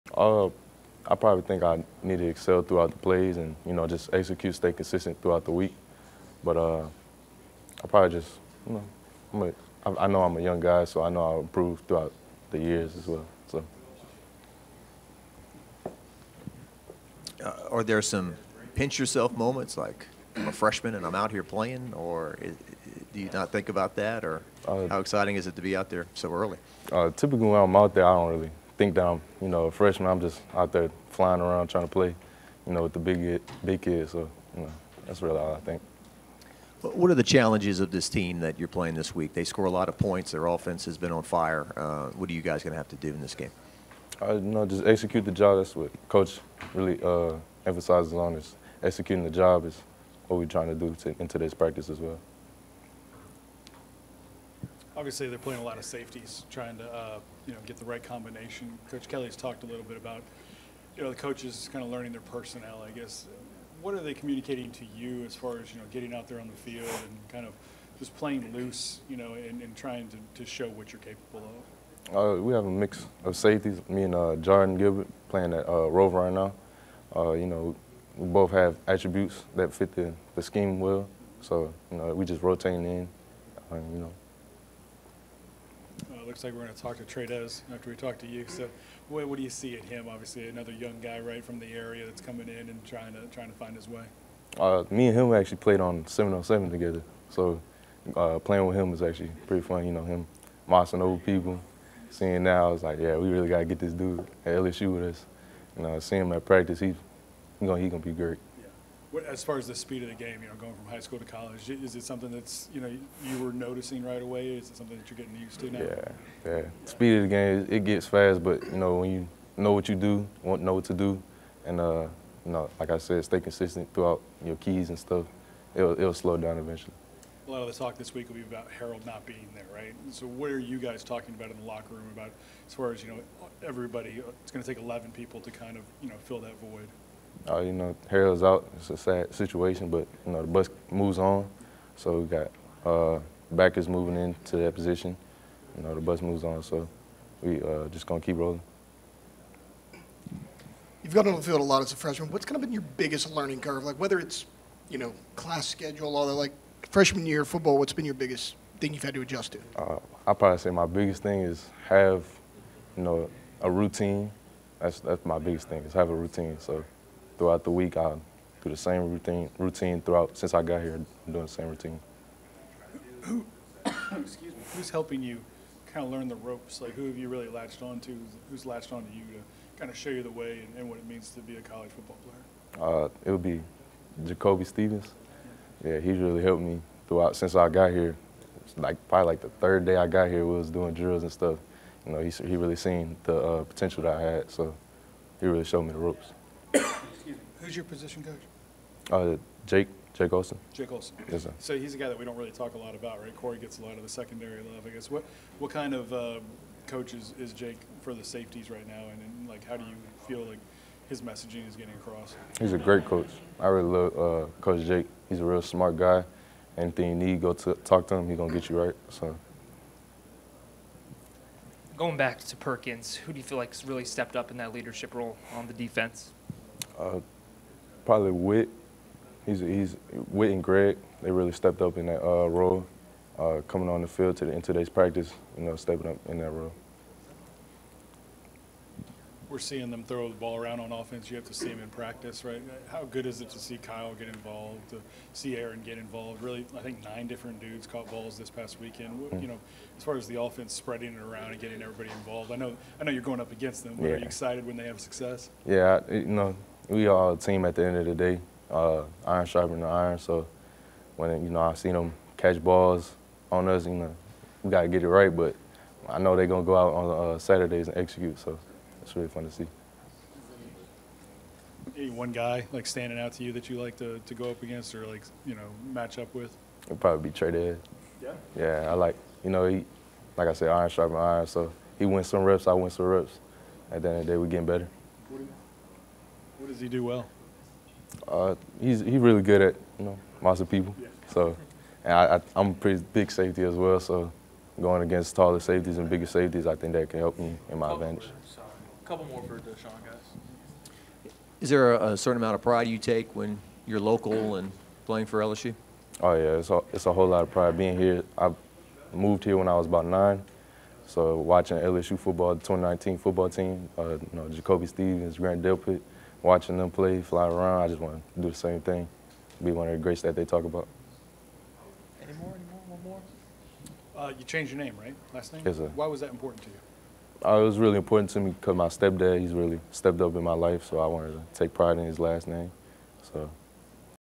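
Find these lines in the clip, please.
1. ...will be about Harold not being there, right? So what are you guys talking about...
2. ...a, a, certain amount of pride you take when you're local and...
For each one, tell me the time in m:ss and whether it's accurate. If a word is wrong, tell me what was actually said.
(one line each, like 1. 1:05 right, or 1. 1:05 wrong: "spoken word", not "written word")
1. 2:08 right
2. 5:01 right.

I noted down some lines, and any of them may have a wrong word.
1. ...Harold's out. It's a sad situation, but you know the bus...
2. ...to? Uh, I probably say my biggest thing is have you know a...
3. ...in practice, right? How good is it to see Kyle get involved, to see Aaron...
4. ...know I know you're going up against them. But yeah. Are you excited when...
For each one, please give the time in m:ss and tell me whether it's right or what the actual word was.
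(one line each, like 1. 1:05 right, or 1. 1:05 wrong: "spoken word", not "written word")
1. 2:18 right
2. 2:39 right
3. 4:01 right
4. 4:12 right.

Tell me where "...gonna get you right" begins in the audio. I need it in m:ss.
3:38.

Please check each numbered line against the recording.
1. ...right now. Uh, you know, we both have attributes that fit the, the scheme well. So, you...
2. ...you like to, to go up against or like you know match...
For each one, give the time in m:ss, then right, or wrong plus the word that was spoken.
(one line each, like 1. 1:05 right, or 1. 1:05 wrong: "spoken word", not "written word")
1. 1:16 right
2. 4:33 right.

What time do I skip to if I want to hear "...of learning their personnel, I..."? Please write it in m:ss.
1:01.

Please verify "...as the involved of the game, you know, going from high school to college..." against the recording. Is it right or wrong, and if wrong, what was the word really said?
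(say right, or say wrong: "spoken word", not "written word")
wrong: "speed", not "involved".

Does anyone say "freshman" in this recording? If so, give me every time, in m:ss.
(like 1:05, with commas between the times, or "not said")
0:20, 0:29, 2:31, 2:36.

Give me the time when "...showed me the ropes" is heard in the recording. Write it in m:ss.
3:15.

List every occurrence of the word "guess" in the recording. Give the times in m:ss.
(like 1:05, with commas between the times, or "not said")
1:02, 3:24.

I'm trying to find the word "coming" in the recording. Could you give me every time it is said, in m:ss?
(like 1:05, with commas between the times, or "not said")
1:32, 3:53.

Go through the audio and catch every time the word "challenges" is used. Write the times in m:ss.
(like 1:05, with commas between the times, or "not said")
0:37.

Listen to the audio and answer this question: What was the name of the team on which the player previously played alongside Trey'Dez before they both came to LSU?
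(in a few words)
707.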